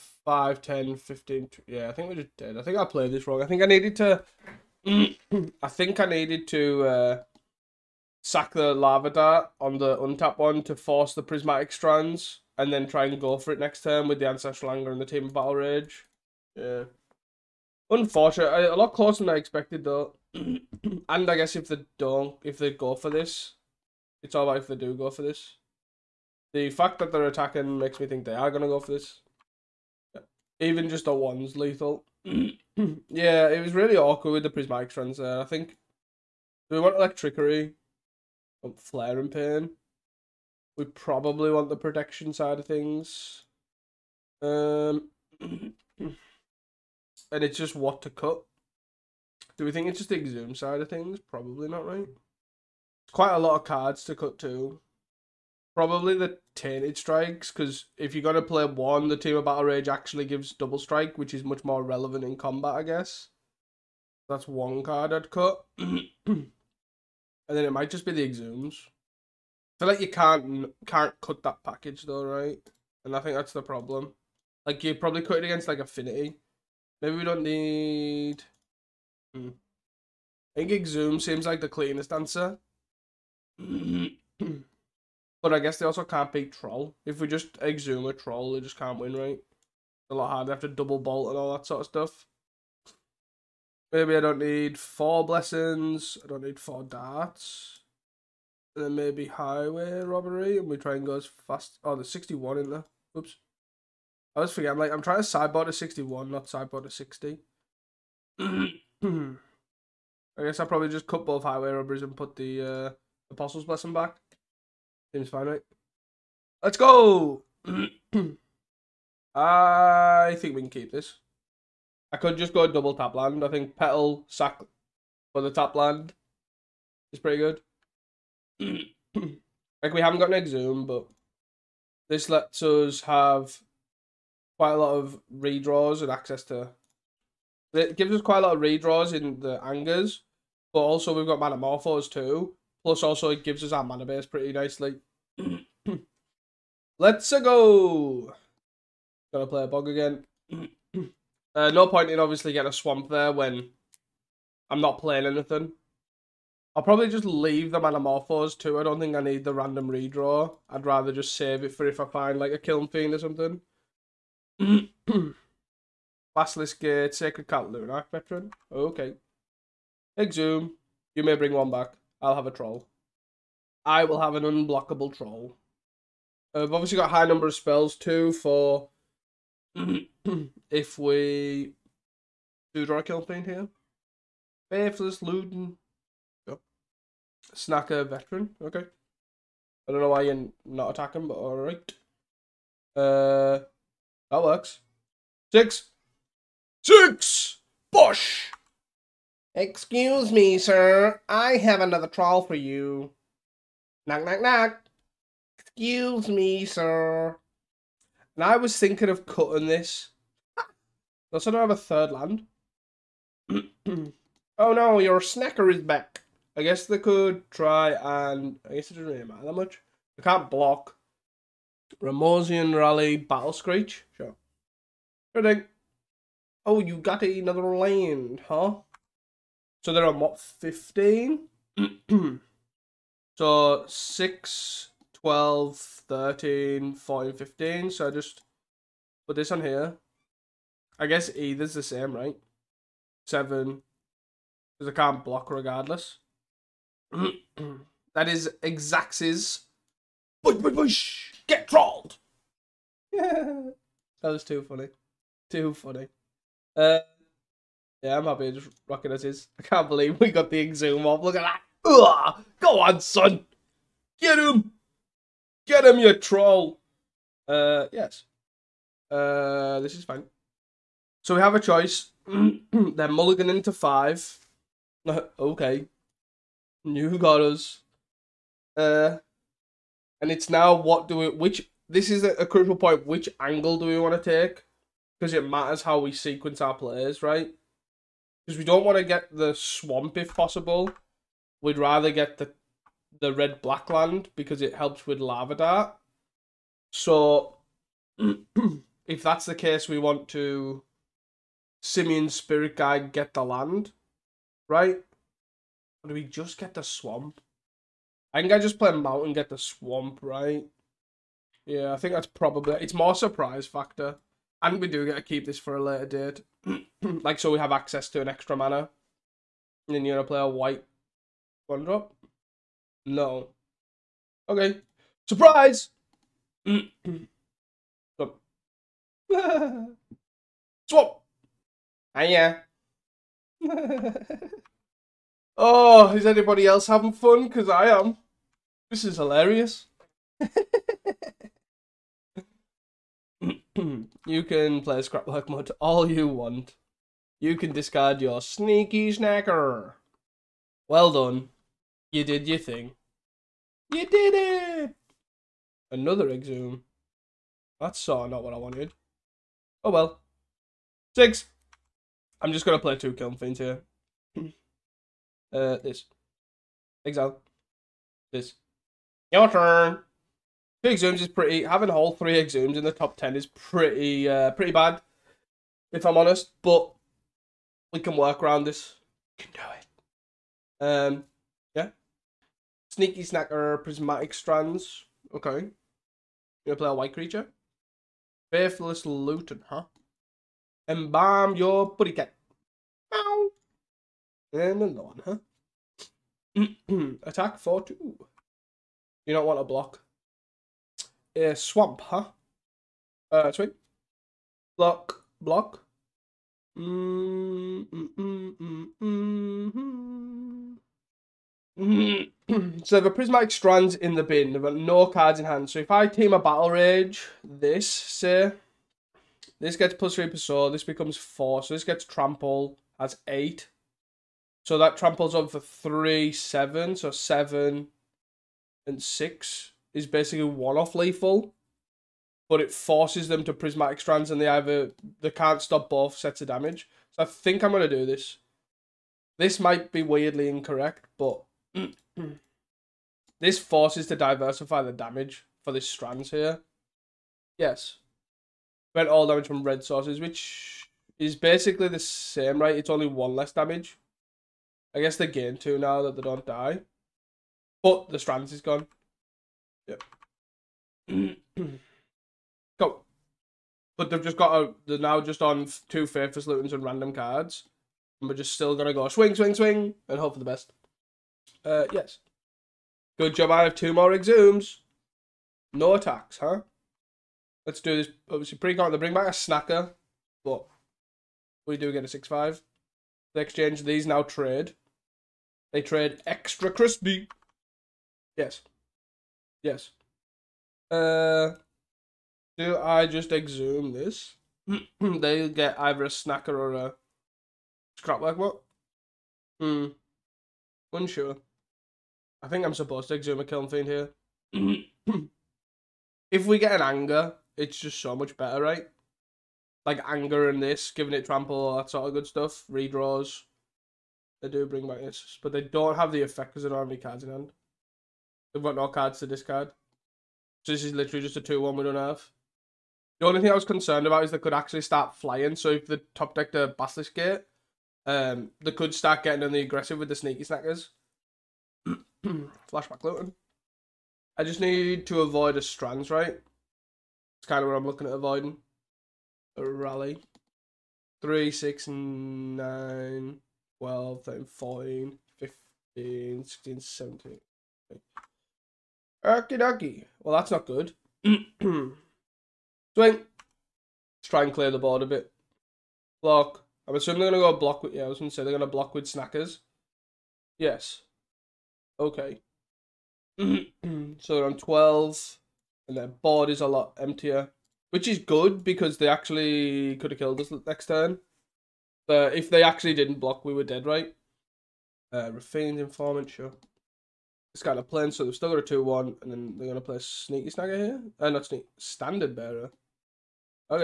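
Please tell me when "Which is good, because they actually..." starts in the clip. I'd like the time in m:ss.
9:27.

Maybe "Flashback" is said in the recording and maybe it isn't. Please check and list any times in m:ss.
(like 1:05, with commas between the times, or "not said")
8:52.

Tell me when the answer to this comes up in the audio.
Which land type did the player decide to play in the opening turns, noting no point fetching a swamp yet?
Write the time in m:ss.
2:29.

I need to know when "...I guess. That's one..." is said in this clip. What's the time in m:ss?
1:02.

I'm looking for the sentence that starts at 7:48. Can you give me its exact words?
And we're just still going to go swing, swing, swing, and hope for the best.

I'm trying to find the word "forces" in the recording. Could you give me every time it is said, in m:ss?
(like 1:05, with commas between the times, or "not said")
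0:10, 7:12, 7:23.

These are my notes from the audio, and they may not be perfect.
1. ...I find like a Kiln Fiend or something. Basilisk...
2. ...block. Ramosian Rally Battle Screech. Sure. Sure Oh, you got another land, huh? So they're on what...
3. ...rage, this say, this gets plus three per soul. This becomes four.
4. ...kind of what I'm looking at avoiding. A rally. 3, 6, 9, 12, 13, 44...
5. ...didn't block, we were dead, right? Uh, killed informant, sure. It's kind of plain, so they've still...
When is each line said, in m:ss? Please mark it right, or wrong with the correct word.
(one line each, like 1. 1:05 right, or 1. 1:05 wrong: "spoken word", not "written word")
1. 2:41 right
2. 3:40 right
3. 6:56 right
4. 8:57 wrong: "14", not "44"
5. 9:32 wrong: "refined", not "killed".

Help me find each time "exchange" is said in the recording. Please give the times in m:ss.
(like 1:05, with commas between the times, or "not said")
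8:03.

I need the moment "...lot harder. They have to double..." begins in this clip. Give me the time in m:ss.
1:30.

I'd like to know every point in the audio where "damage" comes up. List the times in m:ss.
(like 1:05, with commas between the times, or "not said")
7:16, 7:24, 7:29, 7:33.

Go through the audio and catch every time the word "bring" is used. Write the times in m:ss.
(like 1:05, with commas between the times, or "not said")
2:51, 7:58, 8:34.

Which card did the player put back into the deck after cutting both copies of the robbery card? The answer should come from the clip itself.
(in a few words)
Apostle's Blessing.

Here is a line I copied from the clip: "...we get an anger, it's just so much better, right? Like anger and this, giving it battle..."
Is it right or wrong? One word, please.
wrong.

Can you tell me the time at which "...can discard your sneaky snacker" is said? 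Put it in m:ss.
5:47.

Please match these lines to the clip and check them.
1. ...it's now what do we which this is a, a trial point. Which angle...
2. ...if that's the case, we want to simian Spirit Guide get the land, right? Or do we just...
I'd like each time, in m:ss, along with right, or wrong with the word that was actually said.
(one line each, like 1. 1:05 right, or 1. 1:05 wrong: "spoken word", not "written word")
1. 4:40 wrong: "crucial", not "trial"
2. 4:59 right.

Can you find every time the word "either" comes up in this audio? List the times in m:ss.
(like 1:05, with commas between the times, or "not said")
4:01, 7:14, 8:15.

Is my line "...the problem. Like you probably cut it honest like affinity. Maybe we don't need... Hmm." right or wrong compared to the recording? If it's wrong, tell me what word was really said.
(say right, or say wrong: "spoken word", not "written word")
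wrong: "against", not "honest".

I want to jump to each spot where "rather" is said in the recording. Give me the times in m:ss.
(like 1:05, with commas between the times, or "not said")
2:40, 4:51.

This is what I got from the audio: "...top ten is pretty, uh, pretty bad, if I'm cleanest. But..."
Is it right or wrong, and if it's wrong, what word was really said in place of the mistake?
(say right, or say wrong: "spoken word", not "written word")
wrong: "honest", not "cleanest".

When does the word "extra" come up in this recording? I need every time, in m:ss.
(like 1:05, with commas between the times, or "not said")
5:18, 8:06.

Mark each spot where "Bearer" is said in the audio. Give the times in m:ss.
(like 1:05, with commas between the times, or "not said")
9:42.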